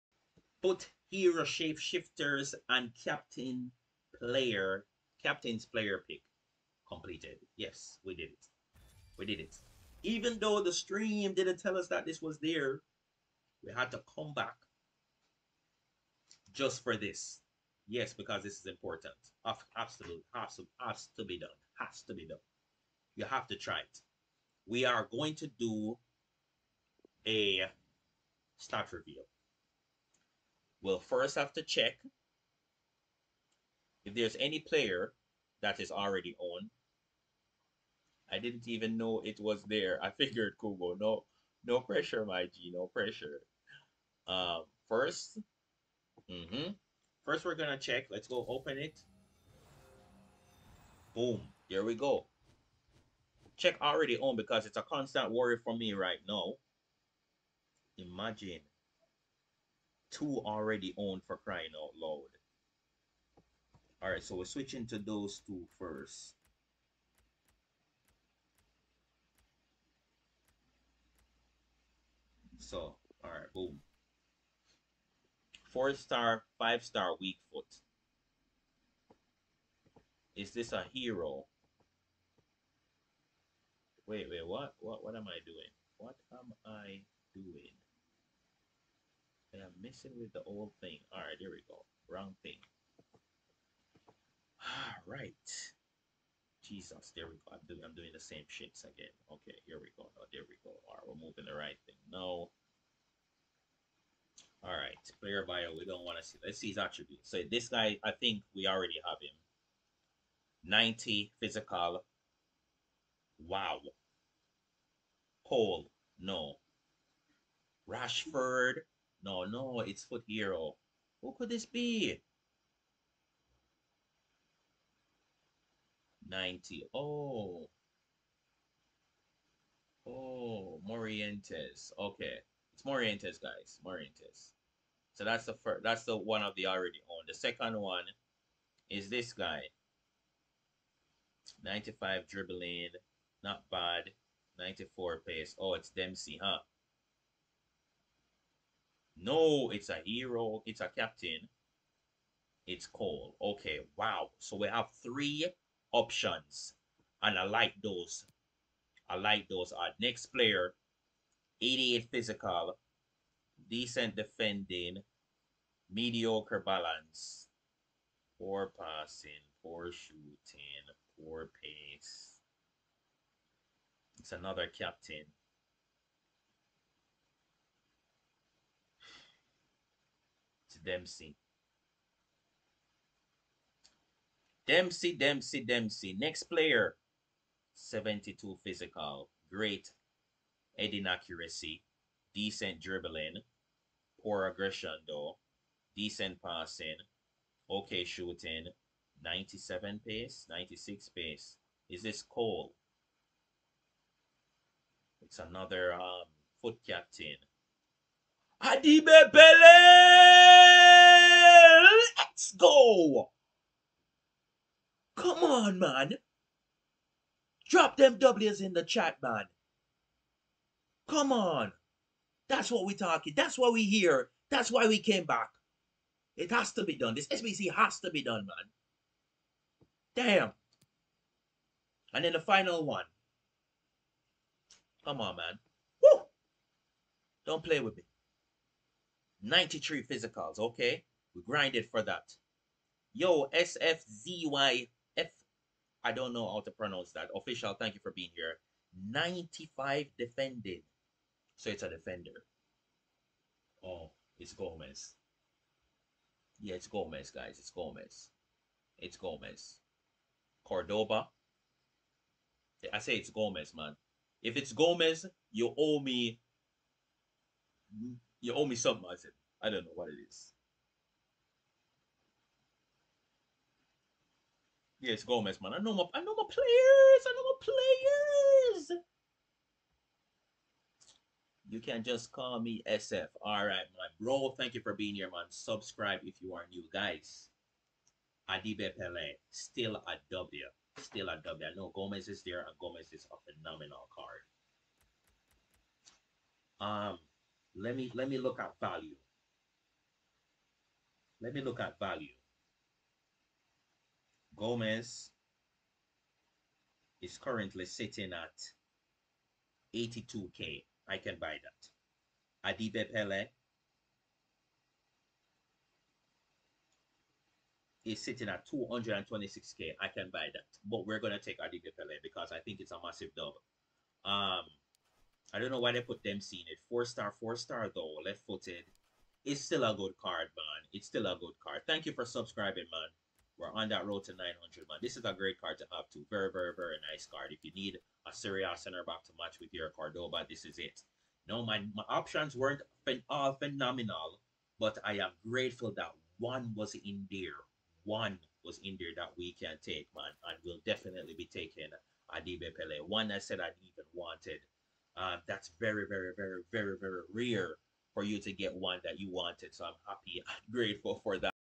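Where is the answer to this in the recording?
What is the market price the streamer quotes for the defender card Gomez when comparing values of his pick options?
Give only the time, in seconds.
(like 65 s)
309 s.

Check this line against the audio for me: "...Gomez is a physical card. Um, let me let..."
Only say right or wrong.
wrong.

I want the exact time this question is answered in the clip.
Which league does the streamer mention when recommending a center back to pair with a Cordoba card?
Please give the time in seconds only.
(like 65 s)
338 s.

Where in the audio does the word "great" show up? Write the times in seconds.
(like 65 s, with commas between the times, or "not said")
189 s, 335 s.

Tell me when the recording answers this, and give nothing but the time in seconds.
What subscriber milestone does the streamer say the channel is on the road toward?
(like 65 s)
334 s.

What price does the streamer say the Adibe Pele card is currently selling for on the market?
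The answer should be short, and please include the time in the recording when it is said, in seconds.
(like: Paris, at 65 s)
226k, at 318 s.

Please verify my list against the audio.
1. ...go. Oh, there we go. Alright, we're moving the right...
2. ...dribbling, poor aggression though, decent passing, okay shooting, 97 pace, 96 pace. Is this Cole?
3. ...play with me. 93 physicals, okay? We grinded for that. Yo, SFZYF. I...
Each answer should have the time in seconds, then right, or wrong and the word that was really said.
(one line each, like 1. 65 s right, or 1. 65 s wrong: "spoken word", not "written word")
1. 99 s right
2. 192 s right
3. 237 s right.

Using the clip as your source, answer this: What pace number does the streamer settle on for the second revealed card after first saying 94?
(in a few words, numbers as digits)
95.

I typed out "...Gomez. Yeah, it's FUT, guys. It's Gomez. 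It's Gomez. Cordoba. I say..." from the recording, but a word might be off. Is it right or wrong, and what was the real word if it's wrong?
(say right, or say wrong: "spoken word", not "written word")
wrong: "Gomez", not "FUT".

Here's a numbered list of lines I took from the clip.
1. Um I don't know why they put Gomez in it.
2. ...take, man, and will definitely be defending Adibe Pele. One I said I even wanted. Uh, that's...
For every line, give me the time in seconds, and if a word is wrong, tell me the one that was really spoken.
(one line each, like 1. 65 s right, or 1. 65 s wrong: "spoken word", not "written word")
1. 324 s wrong: "Dempsey", not "Gomez"
2. 349 s wrong: "taking", not "defending".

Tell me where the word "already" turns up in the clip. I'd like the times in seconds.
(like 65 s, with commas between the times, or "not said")
35 s, 53 s, 60 s, 108 s, 136 s.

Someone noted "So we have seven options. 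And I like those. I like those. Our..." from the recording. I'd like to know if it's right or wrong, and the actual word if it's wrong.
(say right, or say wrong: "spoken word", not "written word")
wrong: "three", not "seven".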